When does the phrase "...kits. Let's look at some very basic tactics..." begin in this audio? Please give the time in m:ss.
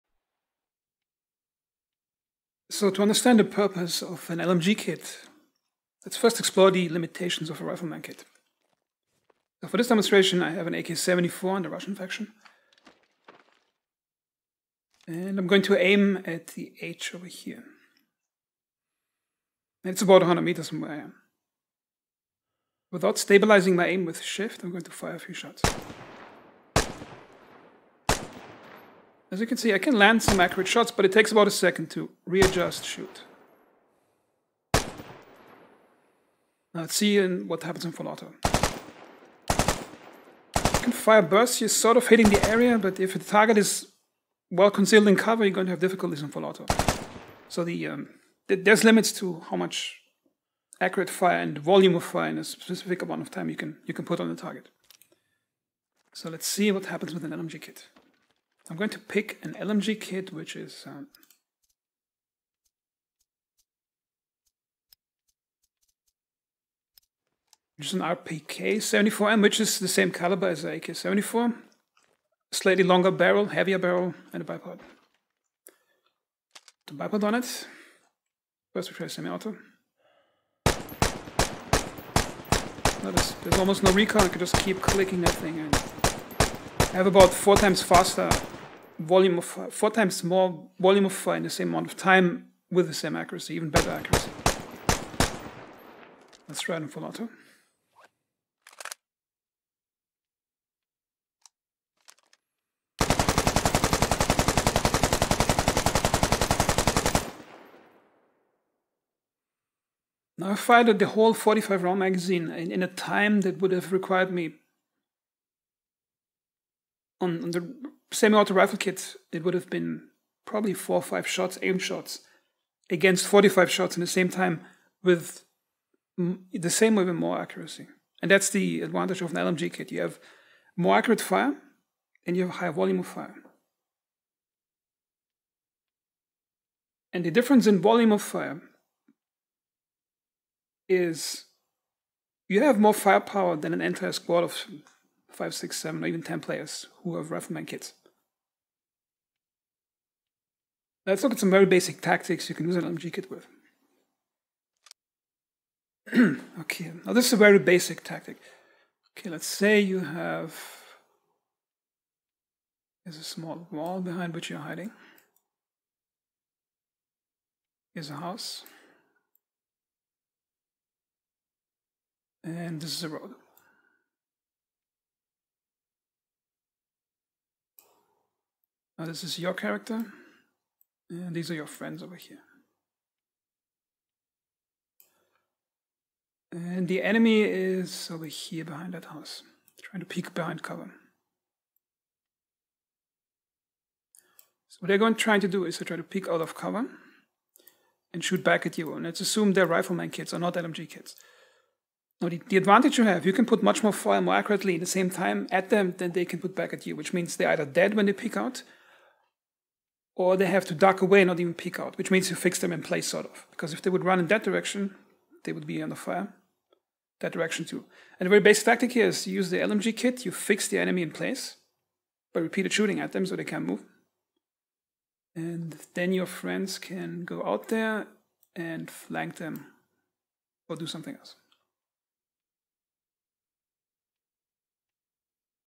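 2:27.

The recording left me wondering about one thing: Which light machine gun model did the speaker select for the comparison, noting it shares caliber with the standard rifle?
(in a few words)
RPK 74M.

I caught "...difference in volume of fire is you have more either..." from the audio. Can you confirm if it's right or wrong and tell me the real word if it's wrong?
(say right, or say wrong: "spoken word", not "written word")
wrong: "firepower", not "either".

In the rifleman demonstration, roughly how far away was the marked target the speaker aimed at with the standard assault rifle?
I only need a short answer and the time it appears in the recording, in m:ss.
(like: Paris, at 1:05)
100 meters, at 0:20.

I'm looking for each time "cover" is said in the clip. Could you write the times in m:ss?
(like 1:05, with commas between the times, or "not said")
0:45, 3:10, 3:16.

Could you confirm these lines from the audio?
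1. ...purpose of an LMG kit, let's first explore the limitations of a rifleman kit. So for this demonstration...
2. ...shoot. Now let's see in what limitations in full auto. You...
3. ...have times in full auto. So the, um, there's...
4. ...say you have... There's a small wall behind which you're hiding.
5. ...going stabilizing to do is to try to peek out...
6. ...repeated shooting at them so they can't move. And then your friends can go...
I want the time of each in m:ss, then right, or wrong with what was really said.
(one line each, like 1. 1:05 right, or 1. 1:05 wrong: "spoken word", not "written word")
1. 0:03 right
2. 0:32 wrong: "happens", not "limitations"
3. 0:45 wrong: "difficulties", not "times"
4. 2:39 right
5. 3:14 wrong: "trying", not "stabilizing"
6. 3:42 right.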